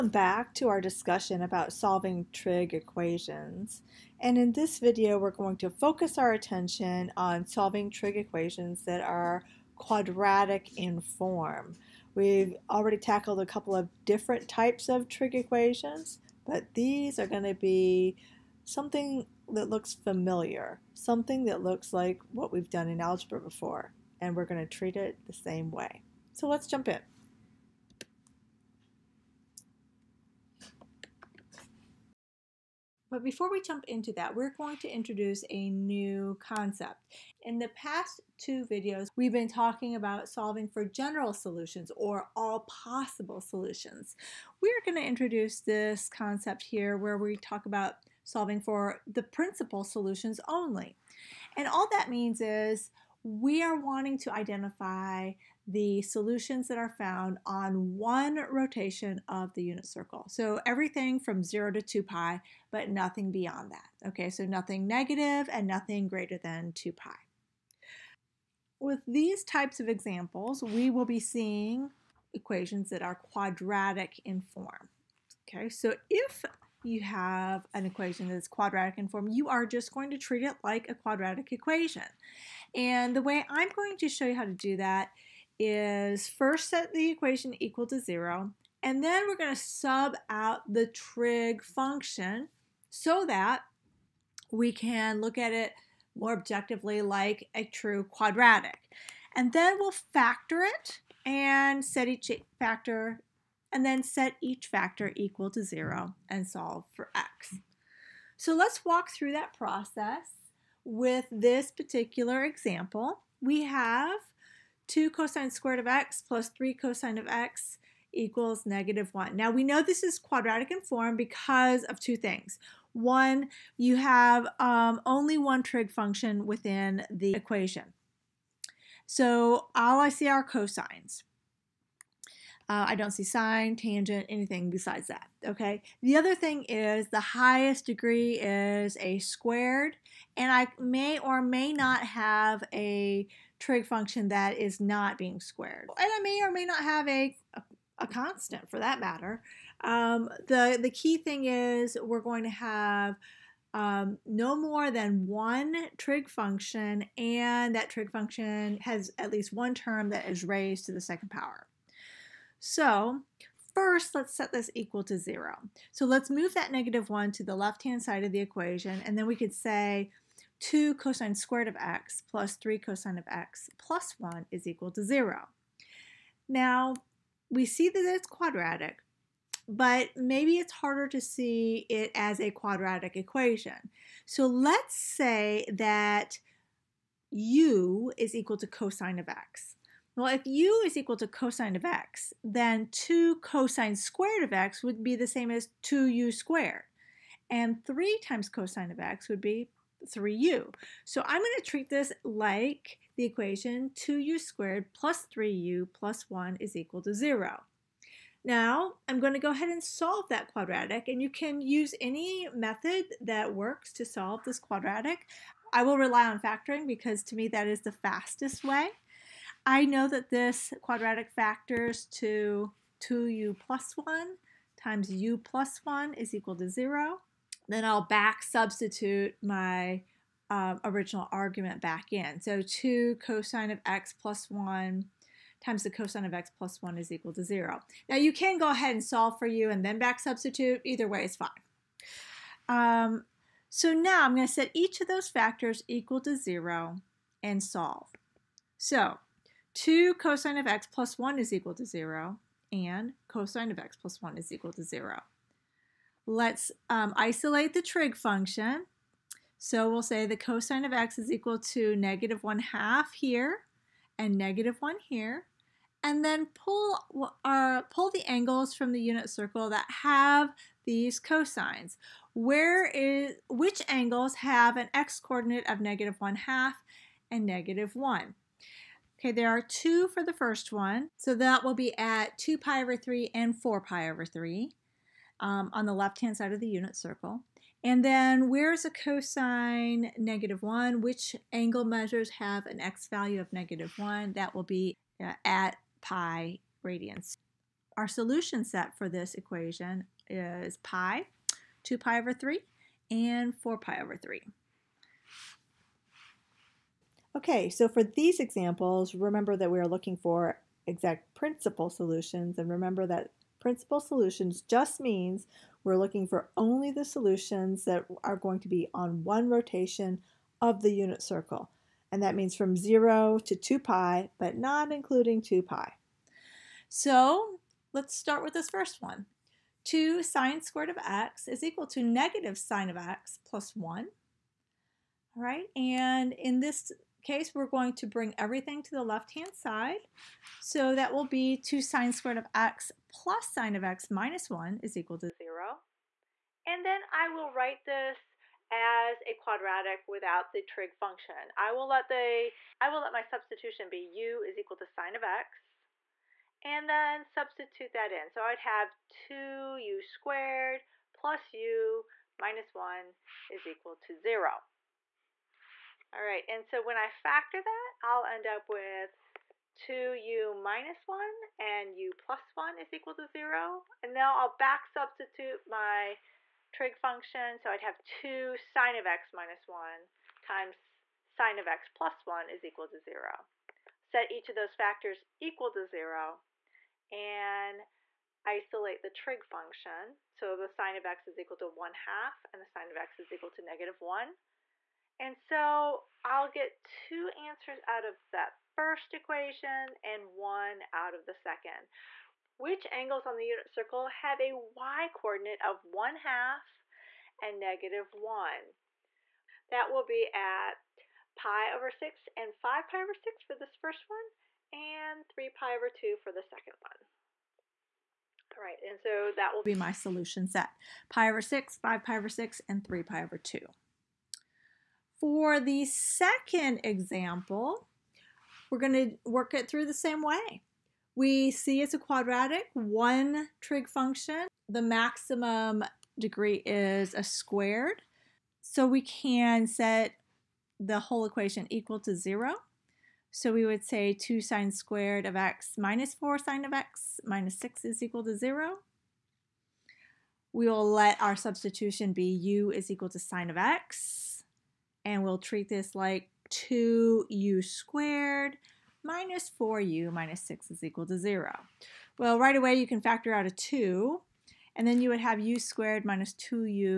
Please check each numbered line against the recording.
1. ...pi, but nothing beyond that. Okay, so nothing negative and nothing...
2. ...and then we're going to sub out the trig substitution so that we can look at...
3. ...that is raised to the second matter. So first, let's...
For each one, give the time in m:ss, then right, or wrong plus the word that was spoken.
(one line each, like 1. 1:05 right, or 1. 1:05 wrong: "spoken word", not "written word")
1. 1:02 right
2. 1:28 wrong: "function", not "substitution"
3. 2:40 wrong: "power", not "matter".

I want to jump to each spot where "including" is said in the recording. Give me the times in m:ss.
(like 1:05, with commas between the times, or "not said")
5:24.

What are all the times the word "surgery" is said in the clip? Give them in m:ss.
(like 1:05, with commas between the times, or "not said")
not said.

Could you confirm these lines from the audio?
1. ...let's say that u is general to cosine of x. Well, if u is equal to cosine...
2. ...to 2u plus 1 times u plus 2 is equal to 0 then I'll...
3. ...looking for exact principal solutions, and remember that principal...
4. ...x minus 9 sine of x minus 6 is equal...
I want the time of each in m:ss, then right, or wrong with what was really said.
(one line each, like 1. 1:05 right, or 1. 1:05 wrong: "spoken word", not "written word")
1. 3:04 wrong: "equal", not "general"
2. 3:42 wrong: "1", not "2"
3. 5:09 right
4. 7:25 wrong: "4", not "9".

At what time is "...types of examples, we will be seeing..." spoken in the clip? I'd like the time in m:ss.
1:09.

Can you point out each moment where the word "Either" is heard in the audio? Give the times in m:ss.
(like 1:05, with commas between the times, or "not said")
4:00.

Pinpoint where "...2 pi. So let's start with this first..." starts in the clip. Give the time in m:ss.
5:25.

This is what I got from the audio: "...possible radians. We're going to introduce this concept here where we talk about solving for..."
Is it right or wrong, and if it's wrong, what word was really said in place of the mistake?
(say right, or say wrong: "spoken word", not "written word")
wrong: "solutions", not "radians".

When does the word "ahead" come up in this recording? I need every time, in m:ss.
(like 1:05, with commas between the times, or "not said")
3:29, 3:58.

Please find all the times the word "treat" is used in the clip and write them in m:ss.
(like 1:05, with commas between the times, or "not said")
0:24, 1:20, 3:21, 7:35.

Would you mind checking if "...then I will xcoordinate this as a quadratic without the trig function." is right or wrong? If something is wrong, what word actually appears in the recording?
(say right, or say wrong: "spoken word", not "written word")
wrong: "write", not "xcoordinate".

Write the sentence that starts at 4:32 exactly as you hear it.
Where is, which angles have an x-coordinate of negative 1 half and negative 1?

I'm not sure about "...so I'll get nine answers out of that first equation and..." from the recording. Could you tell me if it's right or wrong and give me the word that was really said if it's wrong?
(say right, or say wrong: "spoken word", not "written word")
wrong: "two", not "nine".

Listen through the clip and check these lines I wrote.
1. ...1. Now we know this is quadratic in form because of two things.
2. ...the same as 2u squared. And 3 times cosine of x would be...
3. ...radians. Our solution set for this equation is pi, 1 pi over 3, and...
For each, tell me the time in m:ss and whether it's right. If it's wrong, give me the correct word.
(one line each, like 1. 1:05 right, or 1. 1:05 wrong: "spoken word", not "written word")
1. 1:59 right
2. 3:15 right
3. 4:56 wrong: "2", not "1".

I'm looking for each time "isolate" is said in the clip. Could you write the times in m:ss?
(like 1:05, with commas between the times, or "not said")
4:17, 6:28.